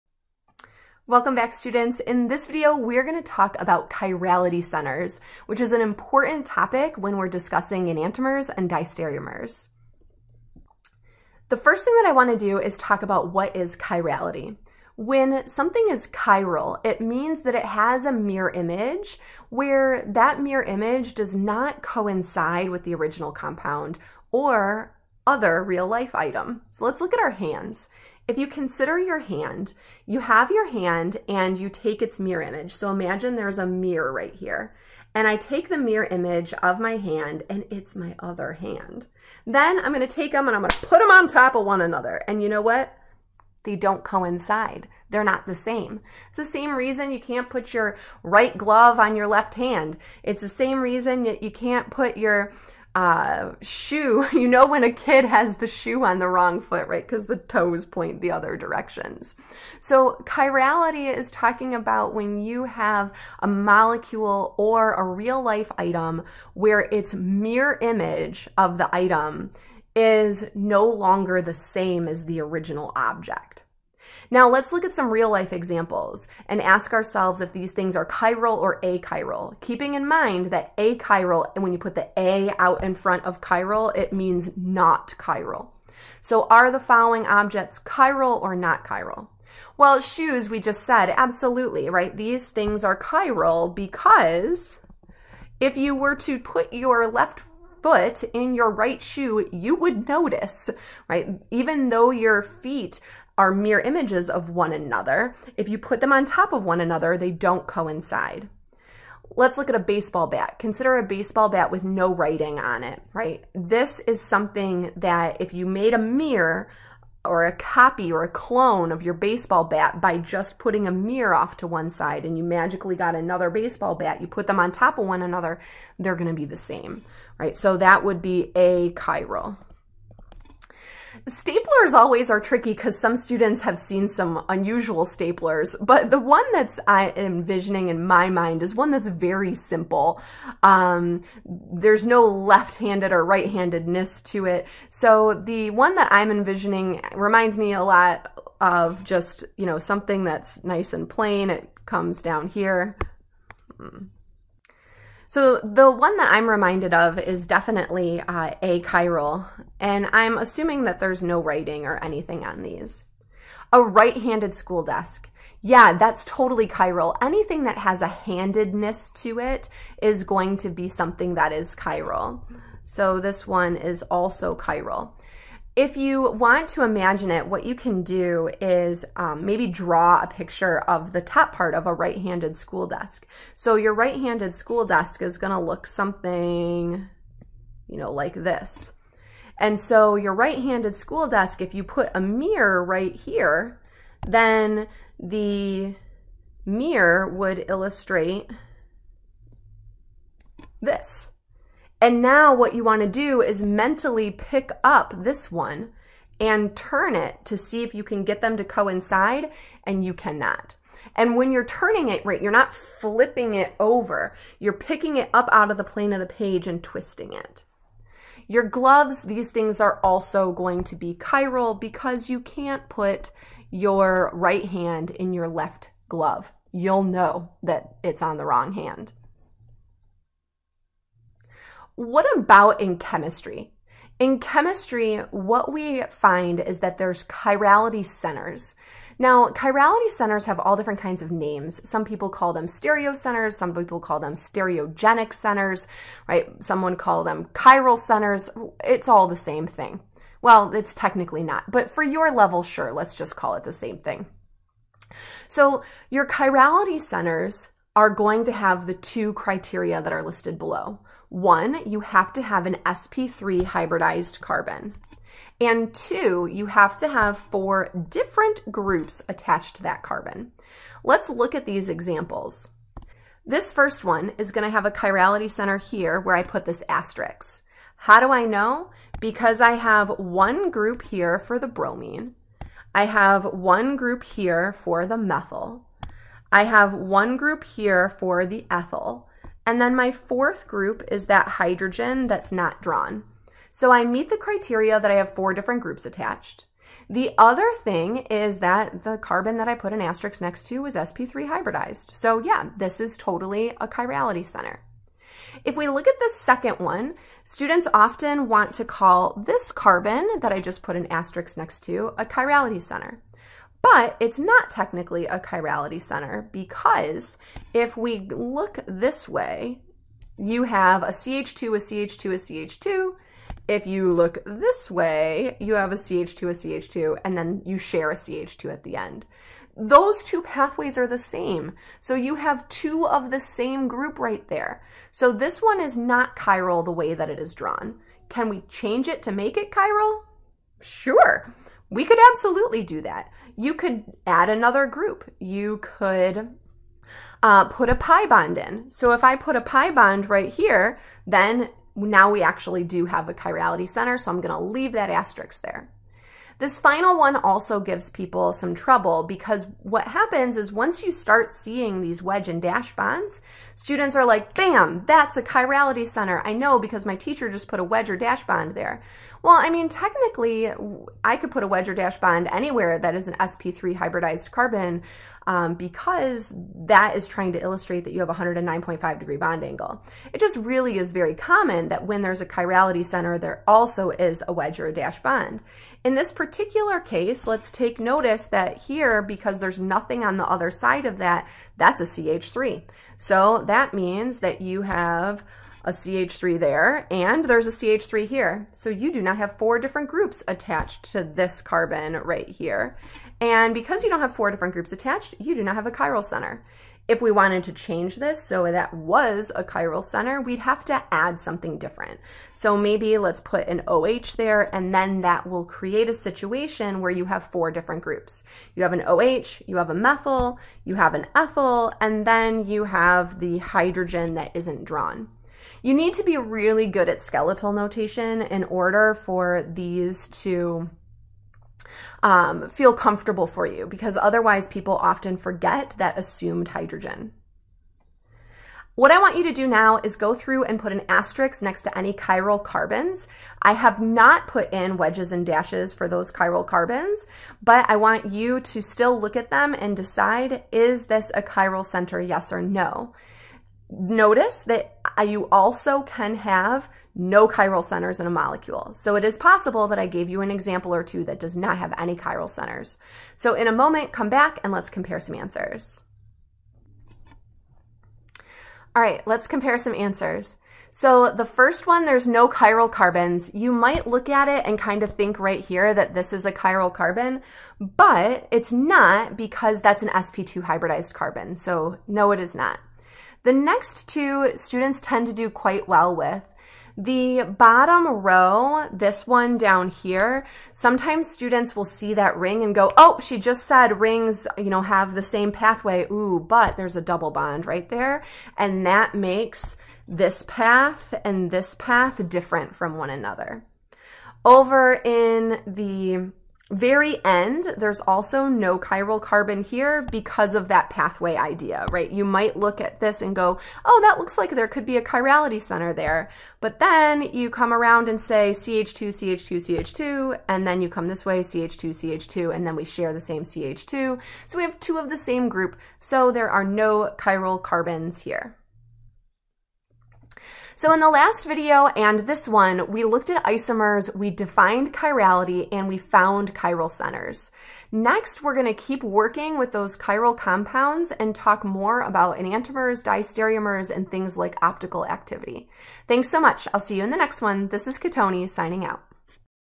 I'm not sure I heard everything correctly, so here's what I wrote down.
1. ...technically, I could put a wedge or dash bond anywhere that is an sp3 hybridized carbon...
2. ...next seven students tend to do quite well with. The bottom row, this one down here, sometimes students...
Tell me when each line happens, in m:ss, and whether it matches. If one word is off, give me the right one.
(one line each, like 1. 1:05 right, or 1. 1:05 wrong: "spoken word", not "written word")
1. 6:09 right
2. 8:03 wrong: "two", not "seven".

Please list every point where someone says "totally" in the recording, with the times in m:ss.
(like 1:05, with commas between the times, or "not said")
2:46, 5:03.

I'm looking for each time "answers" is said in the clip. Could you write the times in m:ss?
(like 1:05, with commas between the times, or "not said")
7:45, 7:49.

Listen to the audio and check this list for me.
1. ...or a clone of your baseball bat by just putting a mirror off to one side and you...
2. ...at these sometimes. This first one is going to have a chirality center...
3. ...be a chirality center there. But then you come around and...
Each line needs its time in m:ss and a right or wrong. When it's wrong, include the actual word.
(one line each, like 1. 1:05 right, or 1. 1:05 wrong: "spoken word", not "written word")
1. 1:58 right
2. 4:31 wrong: "examples", not "sometimes"
3. 8:34 right.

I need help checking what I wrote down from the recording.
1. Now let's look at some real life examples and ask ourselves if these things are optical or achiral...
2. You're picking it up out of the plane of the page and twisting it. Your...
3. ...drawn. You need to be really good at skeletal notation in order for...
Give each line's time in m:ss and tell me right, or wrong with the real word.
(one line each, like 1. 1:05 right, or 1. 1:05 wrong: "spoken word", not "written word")
1. 1:14 wrong: "chiral", not "optical"
2. 3:34 right
3. 7:04 right.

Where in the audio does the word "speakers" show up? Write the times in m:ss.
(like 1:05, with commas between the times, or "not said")
not said.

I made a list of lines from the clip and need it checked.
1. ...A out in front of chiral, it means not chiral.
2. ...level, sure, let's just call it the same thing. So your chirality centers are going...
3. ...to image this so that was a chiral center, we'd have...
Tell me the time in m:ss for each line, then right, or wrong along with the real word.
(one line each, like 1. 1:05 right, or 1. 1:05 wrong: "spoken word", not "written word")
1. 1:22 right
2. 4:12 right
3. 6:47 wrong: "change", not "image".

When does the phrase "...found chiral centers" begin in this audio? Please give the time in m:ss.
8:55.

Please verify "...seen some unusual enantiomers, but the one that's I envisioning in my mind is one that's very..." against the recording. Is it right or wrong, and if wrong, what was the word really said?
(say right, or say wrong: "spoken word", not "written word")
wrong: "staplers", not "enantiomers".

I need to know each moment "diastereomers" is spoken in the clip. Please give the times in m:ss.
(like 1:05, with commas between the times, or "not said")
0:08, 9:03.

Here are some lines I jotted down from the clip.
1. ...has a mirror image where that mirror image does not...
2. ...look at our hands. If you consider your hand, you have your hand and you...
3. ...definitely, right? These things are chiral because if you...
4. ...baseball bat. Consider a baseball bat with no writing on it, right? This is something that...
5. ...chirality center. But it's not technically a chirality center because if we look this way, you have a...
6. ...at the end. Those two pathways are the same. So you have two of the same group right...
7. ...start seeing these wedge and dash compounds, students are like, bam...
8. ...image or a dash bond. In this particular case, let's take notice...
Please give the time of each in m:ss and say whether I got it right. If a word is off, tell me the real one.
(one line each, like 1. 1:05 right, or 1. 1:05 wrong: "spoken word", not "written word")
1. 0:17 right
2. 0:27 right
3. 1:31 wrong: "absolutely", not "definitely"
4. 1:49 right
5. 5:12 right
6. 5:28 right
7. 6:01 wrong: "bonds", not "compounds"
8. 6:24 wrong: "wedge", not "image".